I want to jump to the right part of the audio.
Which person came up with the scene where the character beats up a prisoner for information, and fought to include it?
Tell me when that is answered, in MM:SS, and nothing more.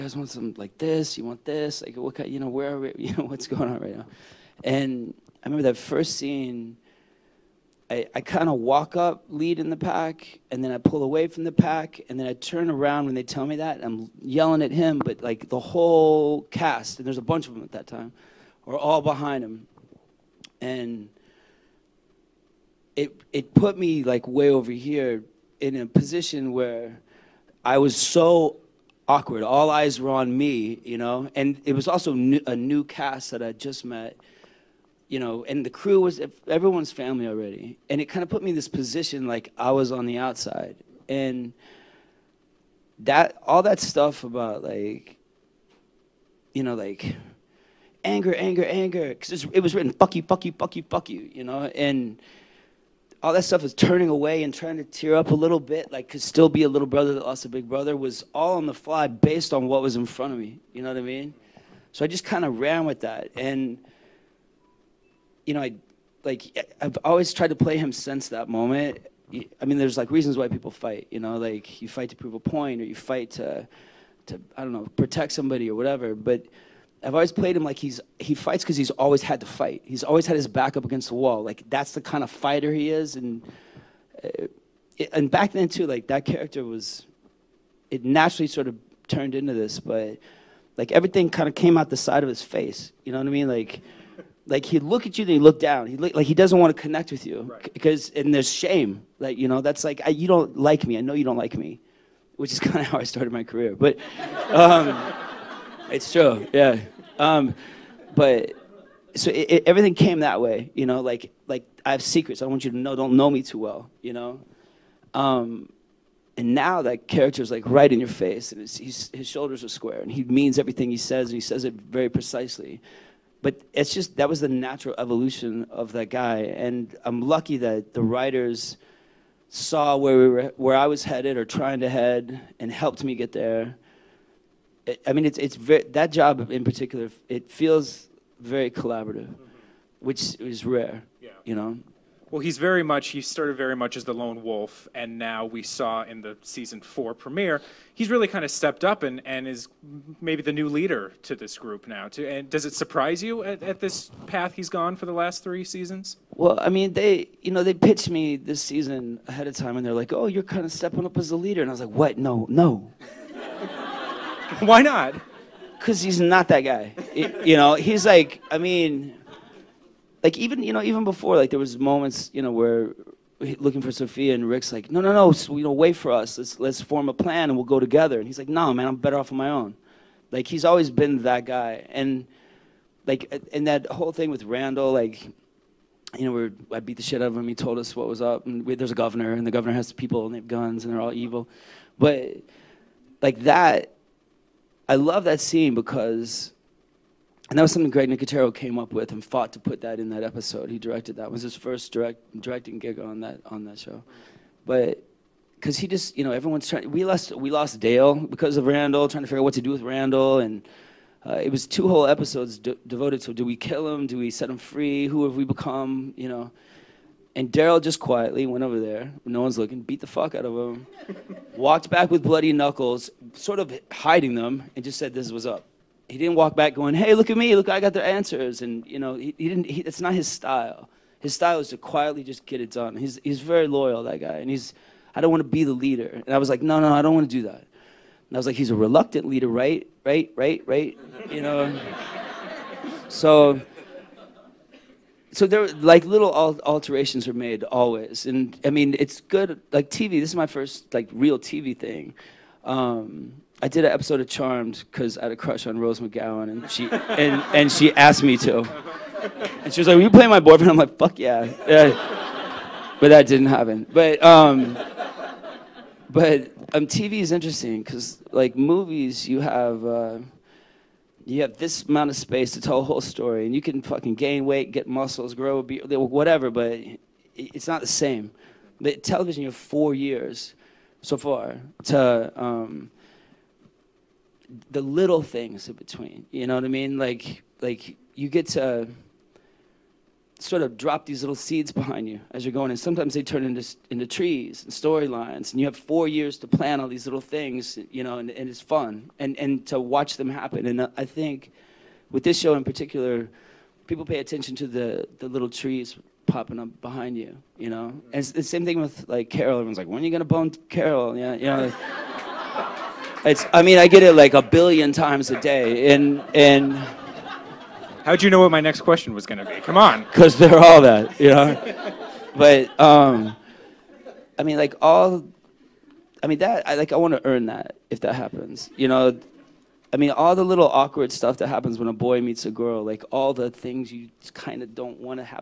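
03:17.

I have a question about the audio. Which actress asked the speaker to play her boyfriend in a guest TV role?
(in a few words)
Rose McGowan.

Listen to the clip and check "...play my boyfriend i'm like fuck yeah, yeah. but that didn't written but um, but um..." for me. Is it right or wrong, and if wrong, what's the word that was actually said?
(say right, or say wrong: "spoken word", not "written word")
wrong: "happen", not "written".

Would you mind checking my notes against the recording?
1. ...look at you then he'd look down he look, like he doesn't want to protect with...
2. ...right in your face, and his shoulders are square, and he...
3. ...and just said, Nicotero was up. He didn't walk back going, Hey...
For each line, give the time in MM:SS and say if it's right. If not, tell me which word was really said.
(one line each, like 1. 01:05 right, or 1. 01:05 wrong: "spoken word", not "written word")
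1. 01:34 wrong: "connect", not "protect"
2. 01:57 right
3. 03:44 wrong: "This", not "Nicotero".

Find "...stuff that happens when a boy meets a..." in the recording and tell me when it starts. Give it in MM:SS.
05:31.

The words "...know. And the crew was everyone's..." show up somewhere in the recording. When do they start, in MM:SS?
00:35.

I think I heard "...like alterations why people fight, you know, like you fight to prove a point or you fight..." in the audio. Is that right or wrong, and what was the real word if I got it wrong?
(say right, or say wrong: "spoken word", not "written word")
wrong: "reasons", not "alterations".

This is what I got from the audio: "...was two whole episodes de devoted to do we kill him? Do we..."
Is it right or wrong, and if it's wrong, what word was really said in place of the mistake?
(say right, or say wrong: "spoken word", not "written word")
right.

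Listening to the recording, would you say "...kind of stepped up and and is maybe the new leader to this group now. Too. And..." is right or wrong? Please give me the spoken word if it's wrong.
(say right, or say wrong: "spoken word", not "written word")
right.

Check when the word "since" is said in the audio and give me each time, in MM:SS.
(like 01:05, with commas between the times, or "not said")
01:07.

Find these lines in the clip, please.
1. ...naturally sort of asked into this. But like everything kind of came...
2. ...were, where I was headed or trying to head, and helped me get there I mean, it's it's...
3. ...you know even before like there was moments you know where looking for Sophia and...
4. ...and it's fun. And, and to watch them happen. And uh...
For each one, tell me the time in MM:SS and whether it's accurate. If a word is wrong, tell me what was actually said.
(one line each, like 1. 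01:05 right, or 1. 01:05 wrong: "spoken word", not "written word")
1. 01:28 wrong: "turned", not "asked"
2. 02:10 right
3. 02:50 right
4. 04:58 right.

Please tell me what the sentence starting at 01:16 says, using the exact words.
But, I've always played him like he's he fights because he's always had to fight.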